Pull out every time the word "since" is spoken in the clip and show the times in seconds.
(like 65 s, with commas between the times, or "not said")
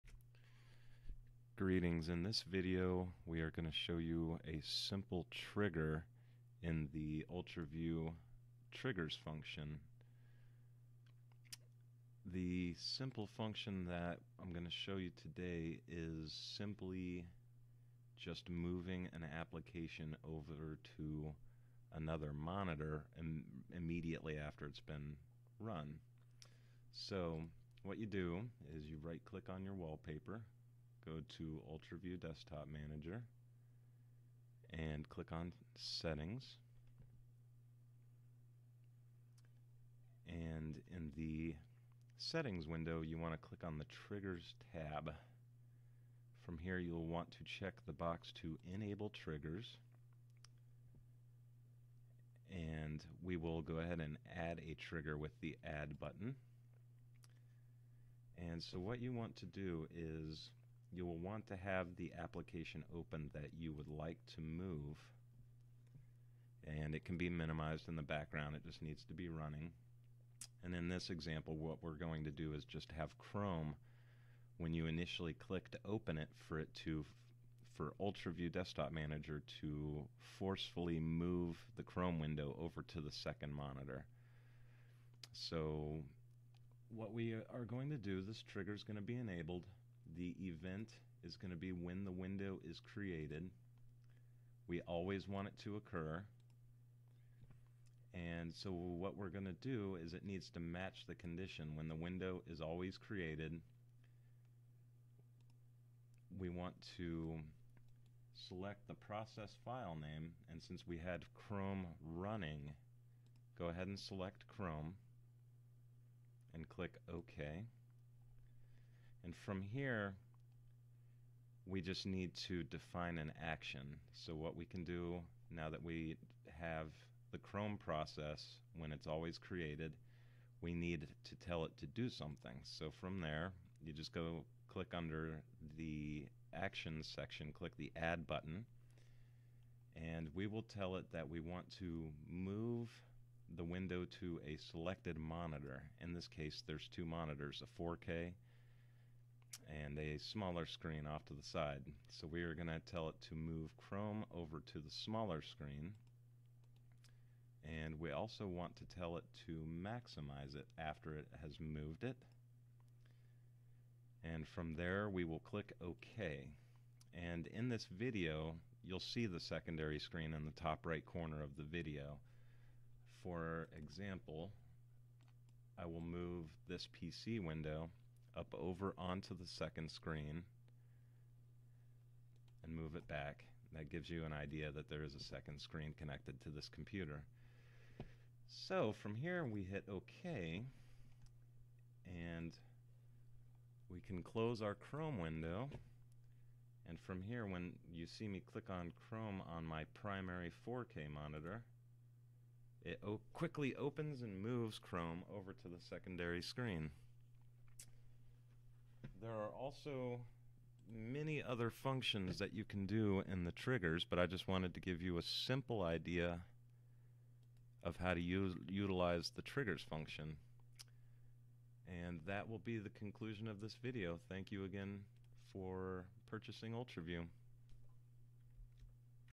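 110 s.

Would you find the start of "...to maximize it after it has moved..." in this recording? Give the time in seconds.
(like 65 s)
159 s.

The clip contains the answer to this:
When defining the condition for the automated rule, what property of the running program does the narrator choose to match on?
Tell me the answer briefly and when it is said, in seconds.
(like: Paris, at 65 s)
process file name, at 108 s.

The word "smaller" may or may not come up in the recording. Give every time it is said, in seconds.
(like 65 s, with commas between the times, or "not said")
150 s, 154 s.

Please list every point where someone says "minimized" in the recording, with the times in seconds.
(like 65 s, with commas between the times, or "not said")
67 s.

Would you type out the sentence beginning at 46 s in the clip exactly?
From here, you'll want to check the box to Enable Triggers.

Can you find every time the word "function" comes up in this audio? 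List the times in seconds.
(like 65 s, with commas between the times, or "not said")
9 s, 13 s, 211 s, 219 s.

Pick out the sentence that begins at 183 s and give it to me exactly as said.
That gives you an idea that there is a second screen connected to this computer.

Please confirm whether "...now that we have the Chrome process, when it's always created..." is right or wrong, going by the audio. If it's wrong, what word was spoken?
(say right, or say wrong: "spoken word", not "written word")
right.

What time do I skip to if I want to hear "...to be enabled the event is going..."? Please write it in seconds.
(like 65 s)
88 s.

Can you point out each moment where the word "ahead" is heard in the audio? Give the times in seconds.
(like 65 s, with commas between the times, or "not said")
53 s, 113 s.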